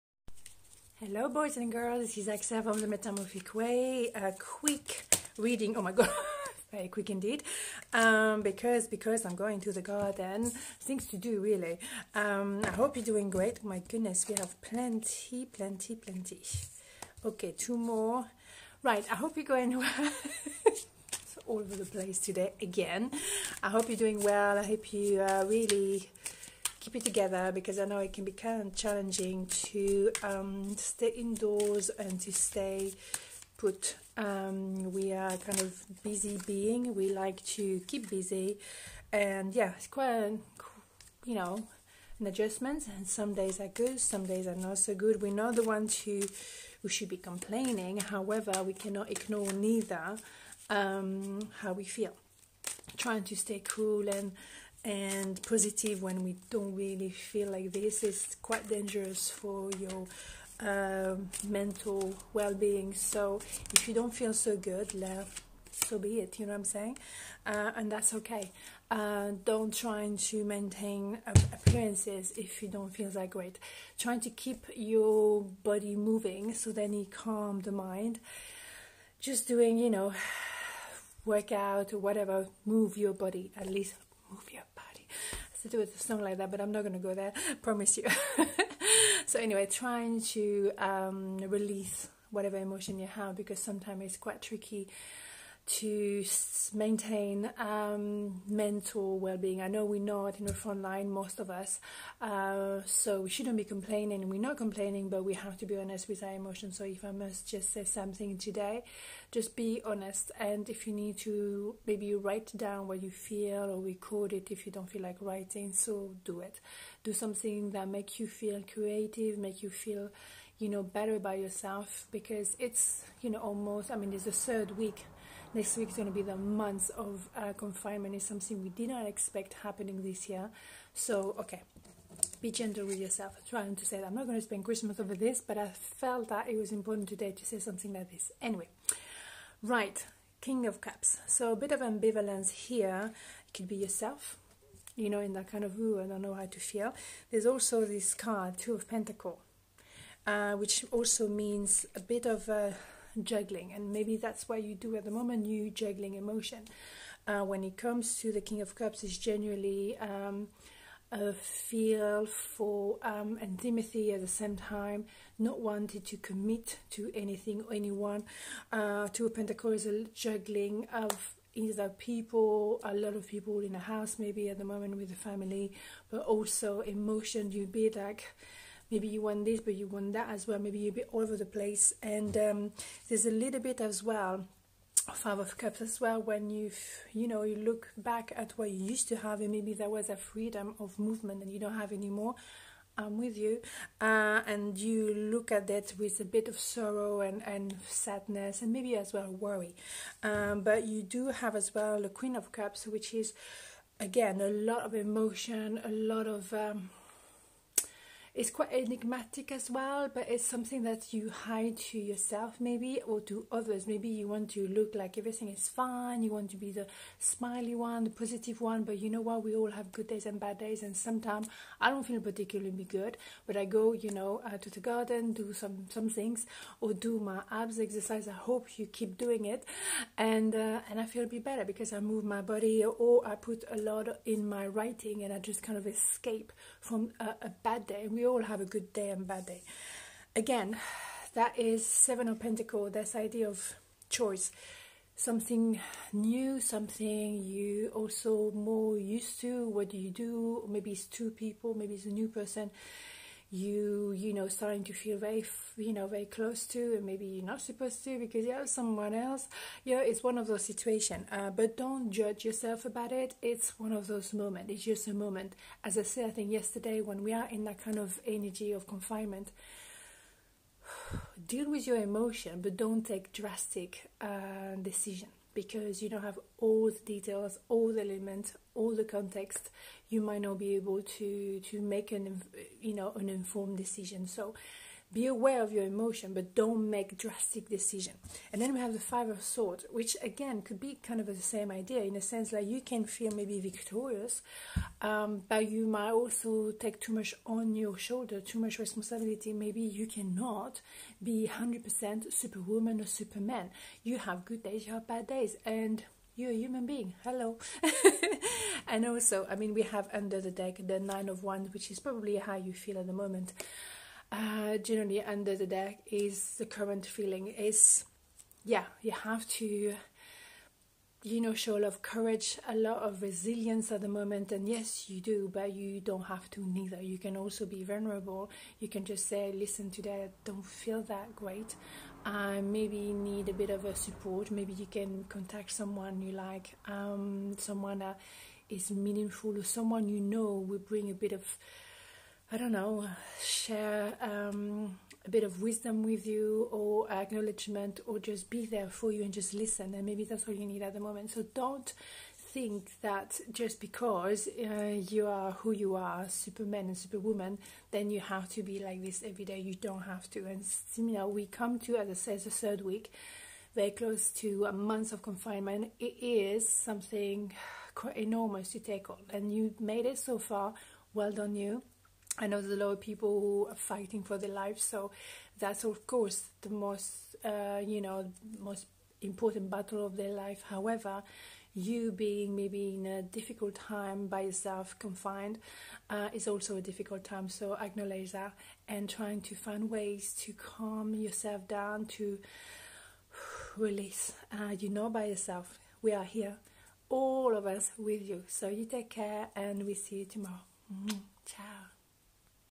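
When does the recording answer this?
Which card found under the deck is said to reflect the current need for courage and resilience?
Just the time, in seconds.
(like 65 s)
310 s.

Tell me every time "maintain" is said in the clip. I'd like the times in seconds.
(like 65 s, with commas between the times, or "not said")
70 s, 96 s.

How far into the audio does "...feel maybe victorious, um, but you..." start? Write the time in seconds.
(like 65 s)
293 s.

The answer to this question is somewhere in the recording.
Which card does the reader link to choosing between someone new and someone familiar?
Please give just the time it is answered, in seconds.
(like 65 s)
241 s.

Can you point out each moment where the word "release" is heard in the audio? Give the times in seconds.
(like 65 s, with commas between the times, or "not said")
91 s, 393 s.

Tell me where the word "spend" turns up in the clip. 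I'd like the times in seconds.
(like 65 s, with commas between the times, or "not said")
134 s.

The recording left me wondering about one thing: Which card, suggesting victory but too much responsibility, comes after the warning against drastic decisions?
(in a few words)
Five of Swords.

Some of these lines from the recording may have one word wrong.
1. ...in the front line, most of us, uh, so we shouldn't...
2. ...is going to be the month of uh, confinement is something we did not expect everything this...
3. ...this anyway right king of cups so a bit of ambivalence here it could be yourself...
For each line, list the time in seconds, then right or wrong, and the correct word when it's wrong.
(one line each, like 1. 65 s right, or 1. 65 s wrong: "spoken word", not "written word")
1. 100 s right
2. 125 s wrong: "happening", not "everything"
3. 138 s right.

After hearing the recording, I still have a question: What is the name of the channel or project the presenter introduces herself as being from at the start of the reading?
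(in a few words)
The Metamorphic Way.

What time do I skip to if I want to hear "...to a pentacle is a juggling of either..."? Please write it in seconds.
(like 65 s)
169 s.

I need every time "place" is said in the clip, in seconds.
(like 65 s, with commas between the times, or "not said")
21 s, 181 s.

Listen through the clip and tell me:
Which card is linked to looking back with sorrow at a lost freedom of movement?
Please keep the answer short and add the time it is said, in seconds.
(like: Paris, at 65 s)
Five of Cups, at 185 s.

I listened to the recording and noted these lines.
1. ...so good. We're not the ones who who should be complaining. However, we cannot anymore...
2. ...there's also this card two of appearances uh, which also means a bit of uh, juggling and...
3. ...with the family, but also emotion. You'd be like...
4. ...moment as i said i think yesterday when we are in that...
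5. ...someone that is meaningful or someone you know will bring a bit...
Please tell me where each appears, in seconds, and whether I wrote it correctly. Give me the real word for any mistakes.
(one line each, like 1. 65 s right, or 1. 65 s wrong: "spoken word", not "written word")
1. 44 s wrong: "ignore", not "anymore"
2. 147 s wrong: "pentacles", not "appearances"
3. 174 s right
4. 265 s right
5. 337 s right.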